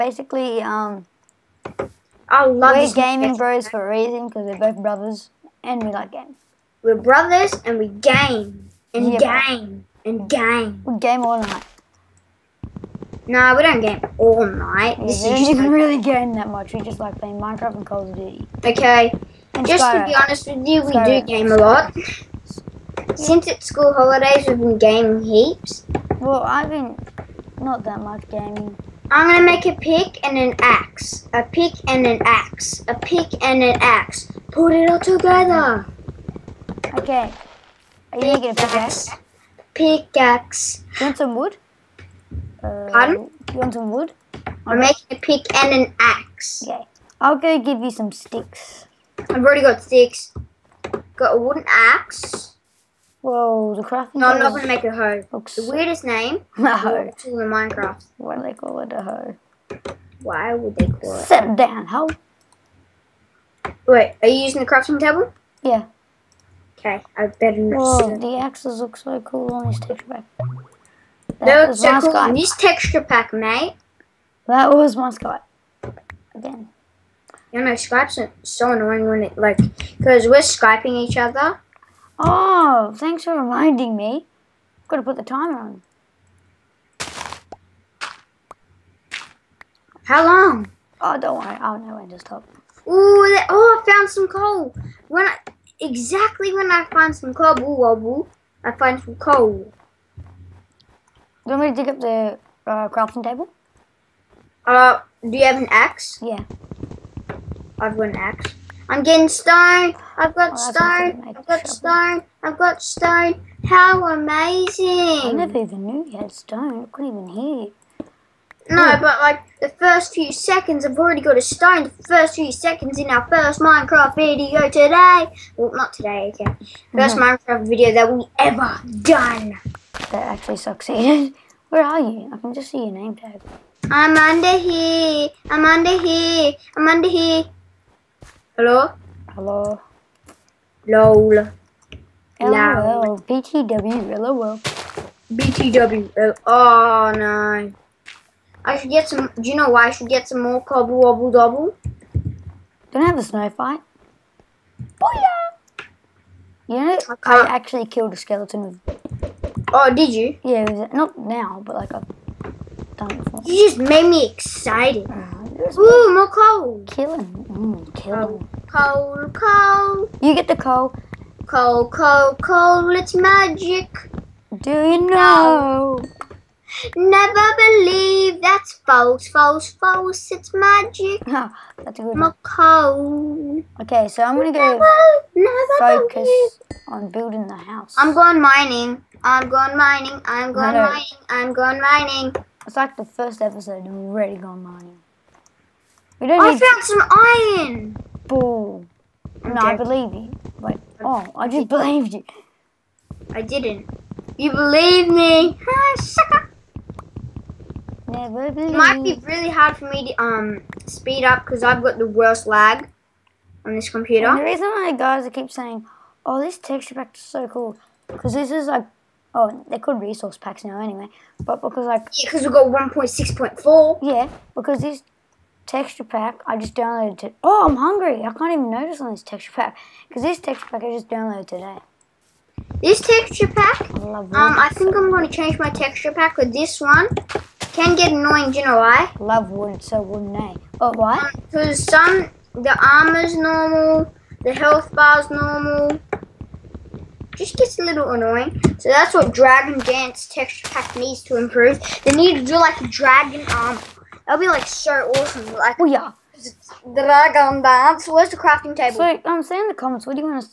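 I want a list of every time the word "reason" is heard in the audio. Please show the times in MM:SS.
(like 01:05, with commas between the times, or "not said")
00:03, 03:34.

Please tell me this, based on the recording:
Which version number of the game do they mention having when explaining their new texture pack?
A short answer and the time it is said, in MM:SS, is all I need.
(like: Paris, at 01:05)
1.6.4, at 03:42.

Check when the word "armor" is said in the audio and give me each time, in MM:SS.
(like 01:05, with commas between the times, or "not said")
04:02, 04:13.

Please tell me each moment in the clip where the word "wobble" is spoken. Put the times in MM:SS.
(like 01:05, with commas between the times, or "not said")
01:37, 02:30.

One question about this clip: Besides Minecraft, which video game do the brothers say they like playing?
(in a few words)
Call of Duty.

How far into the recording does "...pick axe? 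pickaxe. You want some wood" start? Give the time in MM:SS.
00:38.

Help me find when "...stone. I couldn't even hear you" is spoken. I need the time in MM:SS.
01:56.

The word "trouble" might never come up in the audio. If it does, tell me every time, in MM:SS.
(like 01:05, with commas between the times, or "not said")
01:51.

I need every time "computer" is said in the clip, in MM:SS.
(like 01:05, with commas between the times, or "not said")
03:33.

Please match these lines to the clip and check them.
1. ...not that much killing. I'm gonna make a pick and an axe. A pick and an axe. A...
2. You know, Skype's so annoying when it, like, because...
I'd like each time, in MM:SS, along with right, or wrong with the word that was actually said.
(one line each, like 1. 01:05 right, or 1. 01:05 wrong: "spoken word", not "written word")
1. 00:27 wrong: "gaming", not "killing"
2. 01:17 right.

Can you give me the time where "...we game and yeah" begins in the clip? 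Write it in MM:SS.
00:07.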